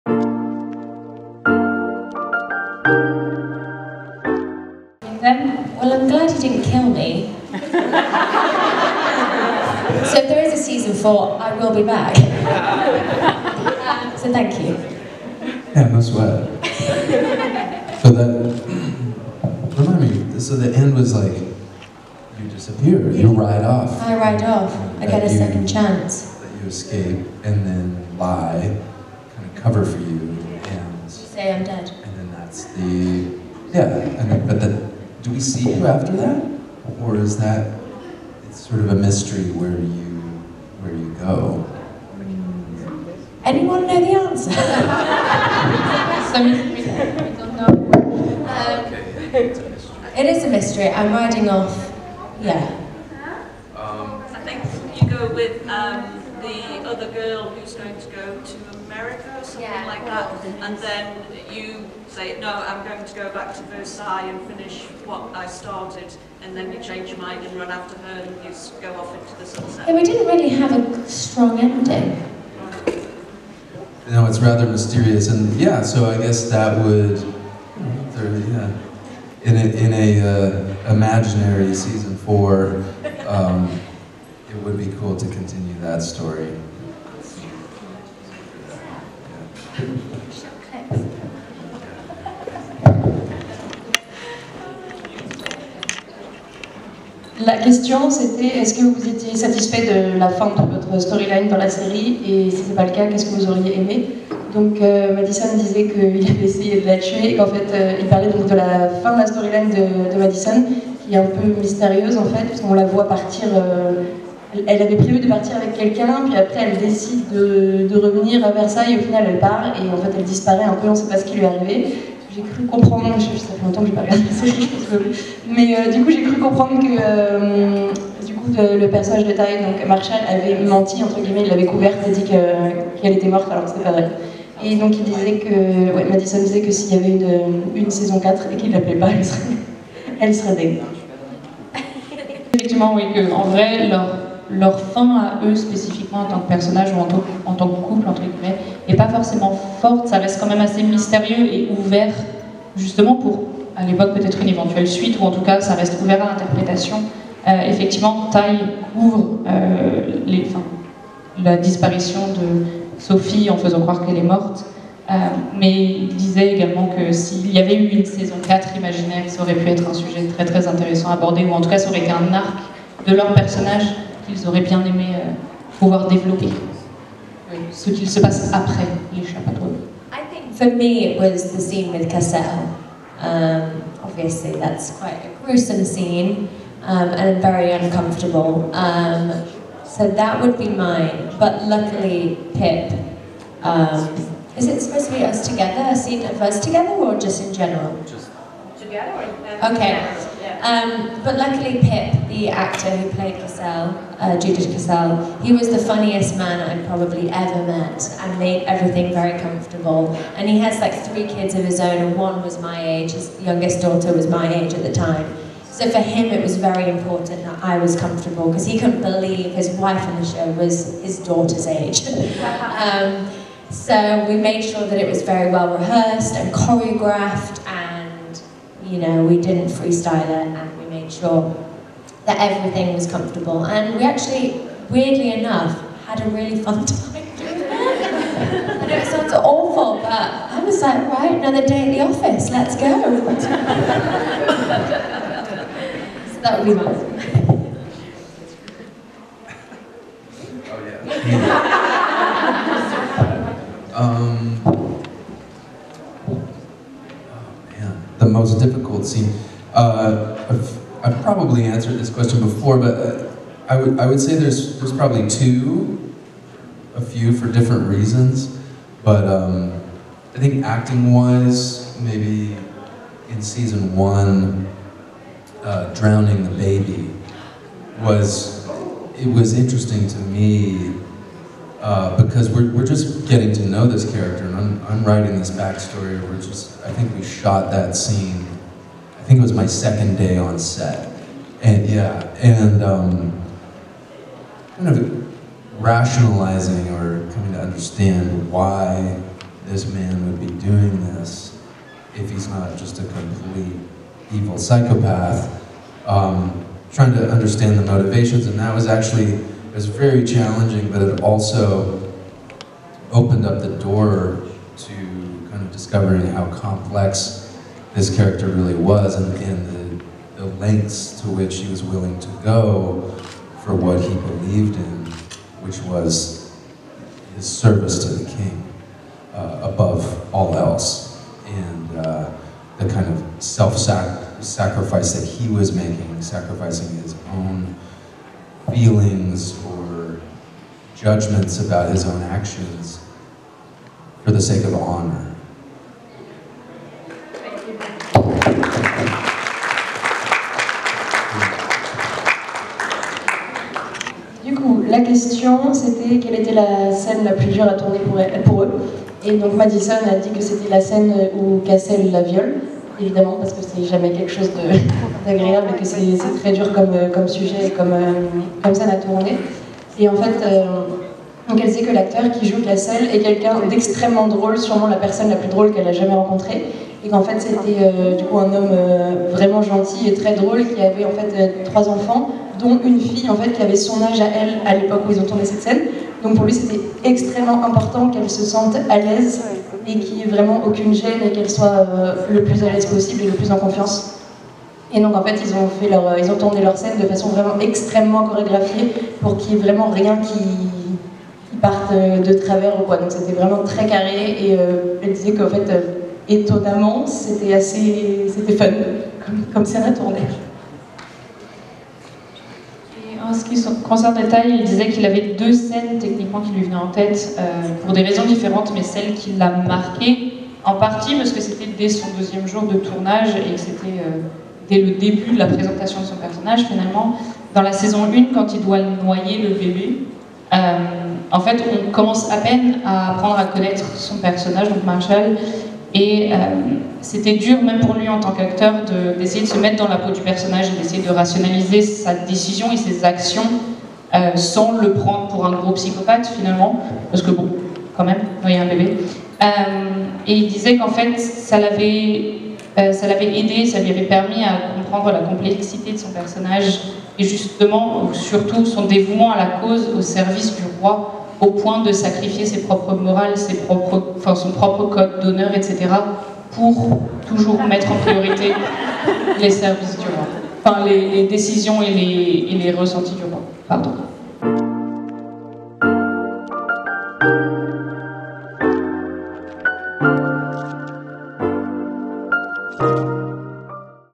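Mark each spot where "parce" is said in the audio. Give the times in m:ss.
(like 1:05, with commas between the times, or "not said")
6:03, 7:01, 7:27.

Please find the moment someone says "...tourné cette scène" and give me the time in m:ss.
6:25.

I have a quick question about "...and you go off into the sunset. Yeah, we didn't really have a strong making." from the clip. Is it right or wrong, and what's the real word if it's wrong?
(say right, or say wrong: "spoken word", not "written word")
wrong: "ending", not "making".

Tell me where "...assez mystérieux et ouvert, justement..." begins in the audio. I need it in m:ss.
2:30.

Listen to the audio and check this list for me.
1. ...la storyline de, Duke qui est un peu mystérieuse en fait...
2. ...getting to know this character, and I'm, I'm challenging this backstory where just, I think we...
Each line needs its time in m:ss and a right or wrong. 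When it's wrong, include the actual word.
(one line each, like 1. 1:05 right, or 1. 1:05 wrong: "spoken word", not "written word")
1. 1:49 wrong: "Madison", not "Duke"
2. 4:43 wrong: "writing", not "challenging".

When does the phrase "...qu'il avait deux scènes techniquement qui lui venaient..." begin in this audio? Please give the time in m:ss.
6:54.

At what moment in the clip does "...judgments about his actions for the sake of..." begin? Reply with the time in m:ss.
5:40.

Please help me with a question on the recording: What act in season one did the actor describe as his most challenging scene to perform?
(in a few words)
drowning the baby.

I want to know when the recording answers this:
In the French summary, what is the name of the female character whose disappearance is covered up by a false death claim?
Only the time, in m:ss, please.
2:42.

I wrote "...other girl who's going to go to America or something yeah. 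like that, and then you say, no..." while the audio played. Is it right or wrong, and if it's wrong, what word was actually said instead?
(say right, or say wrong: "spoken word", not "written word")
right.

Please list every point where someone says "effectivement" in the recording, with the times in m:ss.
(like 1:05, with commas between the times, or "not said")
2:22, 2:37.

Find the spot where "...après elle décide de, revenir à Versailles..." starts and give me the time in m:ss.
1:56.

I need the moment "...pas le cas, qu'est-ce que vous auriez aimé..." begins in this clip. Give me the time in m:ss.
1:42.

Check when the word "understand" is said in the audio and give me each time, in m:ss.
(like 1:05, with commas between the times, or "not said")
4:57, 5:07.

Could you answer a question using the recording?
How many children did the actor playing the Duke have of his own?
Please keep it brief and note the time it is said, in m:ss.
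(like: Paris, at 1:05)
3, at 3:30.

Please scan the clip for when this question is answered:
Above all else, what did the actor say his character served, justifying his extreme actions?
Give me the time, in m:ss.
5:28.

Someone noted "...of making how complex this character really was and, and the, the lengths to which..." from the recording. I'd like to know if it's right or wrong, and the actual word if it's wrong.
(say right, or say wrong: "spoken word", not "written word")
wrong: "discovering", not "making".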